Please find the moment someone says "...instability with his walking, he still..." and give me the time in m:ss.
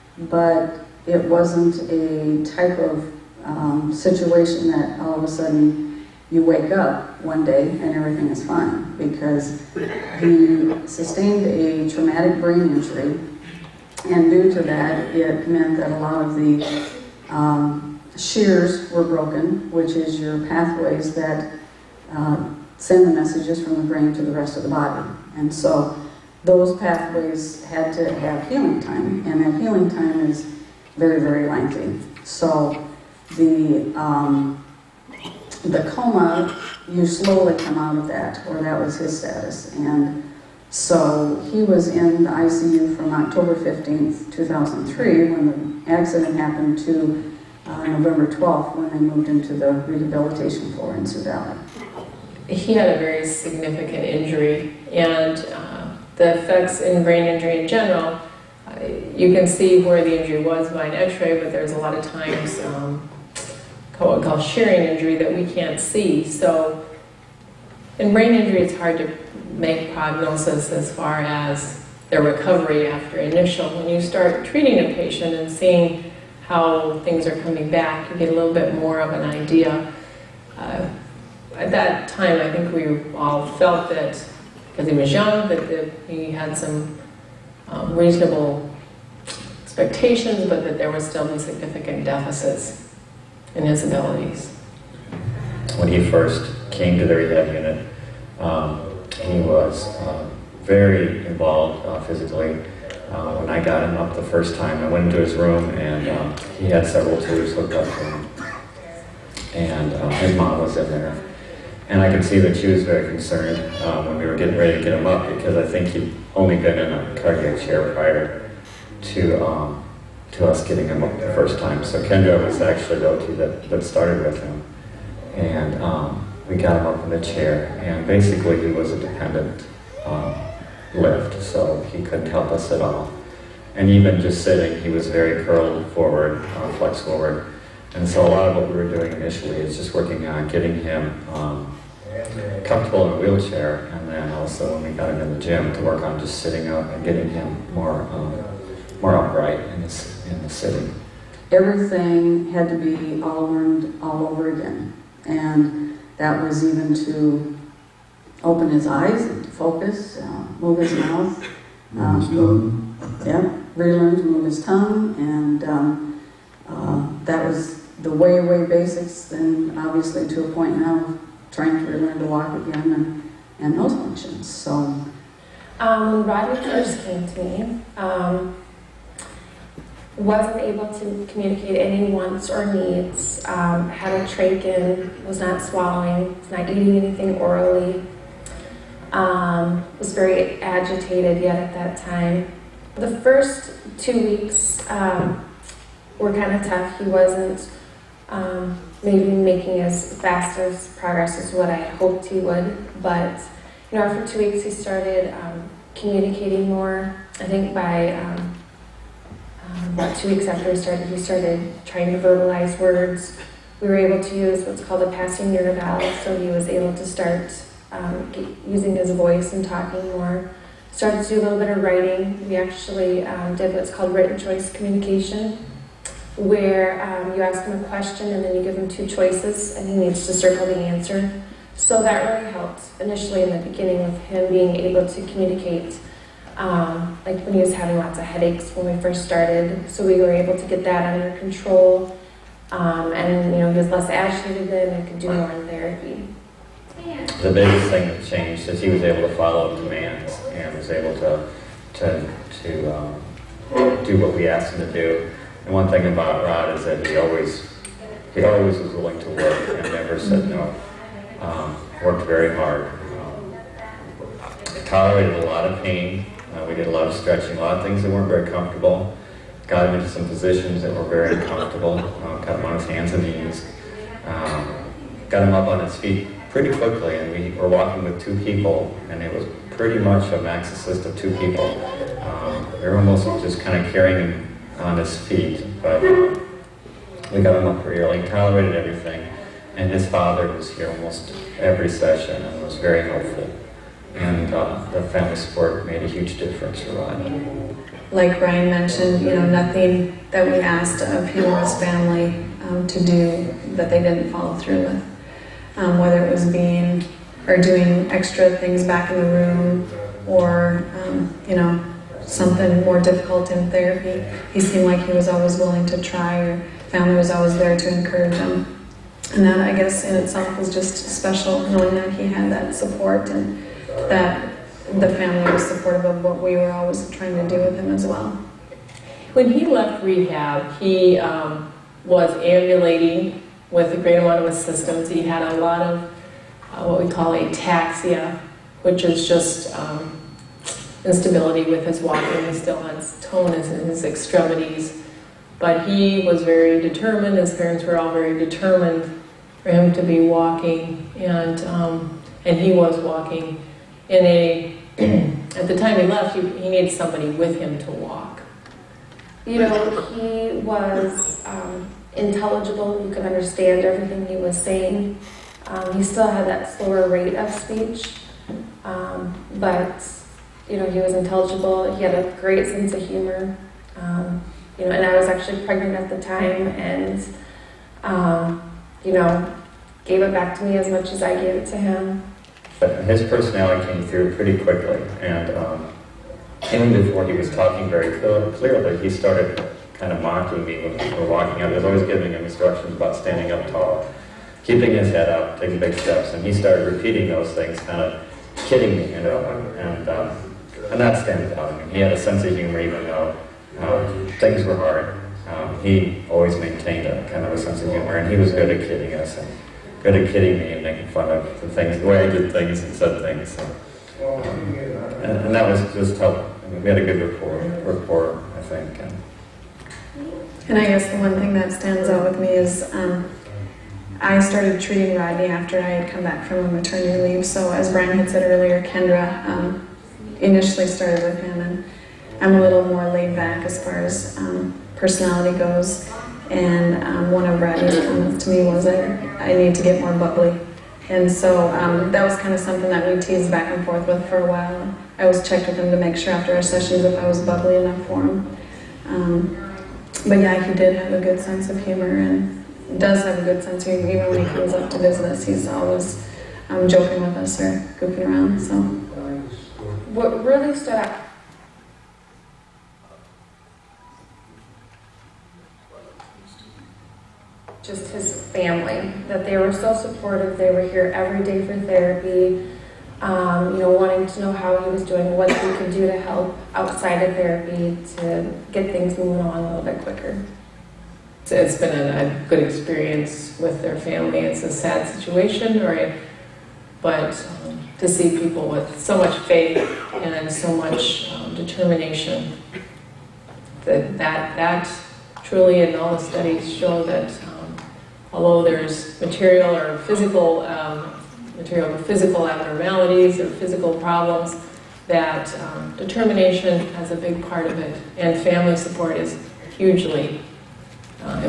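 5:41.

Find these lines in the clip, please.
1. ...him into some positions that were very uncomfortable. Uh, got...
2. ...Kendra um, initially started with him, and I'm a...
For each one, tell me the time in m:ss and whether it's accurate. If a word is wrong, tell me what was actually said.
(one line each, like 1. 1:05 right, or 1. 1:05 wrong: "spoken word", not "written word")
1. 4:29 right
2. 7:08 right.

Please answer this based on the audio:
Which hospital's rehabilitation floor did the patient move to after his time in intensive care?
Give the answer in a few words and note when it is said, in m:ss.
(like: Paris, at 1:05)
Sioux Valley, at 0:51.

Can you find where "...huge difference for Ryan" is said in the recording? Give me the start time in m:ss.
4:56.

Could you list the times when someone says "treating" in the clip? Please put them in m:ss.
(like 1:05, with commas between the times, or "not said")
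1:14, 7:04.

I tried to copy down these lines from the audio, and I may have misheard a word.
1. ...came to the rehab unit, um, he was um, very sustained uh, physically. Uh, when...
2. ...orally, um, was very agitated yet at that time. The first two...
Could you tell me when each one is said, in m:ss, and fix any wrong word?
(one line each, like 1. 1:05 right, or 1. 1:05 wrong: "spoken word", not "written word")
1. 1:36 wrong: "involved", not "sustained"
2. 3:07 right.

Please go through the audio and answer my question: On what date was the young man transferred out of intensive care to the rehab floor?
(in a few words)
November 12.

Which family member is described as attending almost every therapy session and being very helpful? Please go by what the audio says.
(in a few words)
His father.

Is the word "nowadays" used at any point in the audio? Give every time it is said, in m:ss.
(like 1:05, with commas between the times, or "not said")
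not said.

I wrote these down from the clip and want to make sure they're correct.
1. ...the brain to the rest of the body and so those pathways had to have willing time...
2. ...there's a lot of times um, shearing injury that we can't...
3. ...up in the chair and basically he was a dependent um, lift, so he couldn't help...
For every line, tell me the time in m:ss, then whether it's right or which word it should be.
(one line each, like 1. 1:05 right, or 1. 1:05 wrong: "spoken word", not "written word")
1. 0:23 wrong: "healing", not "willing"
2. 1:01 right
3. 2:06 right.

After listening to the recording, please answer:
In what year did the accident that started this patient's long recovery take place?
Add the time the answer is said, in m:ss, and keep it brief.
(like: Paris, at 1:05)
2003, at 0:44.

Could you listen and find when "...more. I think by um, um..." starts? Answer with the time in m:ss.
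3:26.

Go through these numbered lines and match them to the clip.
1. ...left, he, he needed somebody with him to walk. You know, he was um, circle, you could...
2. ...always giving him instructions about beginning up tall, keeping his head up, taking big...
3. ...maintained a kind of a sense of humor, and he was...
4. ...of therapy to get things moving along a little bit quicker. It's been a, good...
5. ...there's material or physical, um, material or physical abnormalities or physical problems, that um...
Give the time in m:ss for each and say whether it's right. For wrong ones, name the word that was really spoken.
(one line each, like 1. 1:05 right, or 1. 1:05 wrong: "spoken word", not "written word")
1. 5:56 wrong: "intelligible", not "circle"
2. 6:31 wrong: "standing", not "beginning"
3. 6:46 right
4. 7:57 right
5. 8:18 right.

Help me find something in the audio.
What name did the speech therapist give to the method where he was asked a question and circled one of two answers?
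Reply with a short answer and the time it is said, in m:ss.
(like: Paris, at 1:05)
written choice communication, at 3:44.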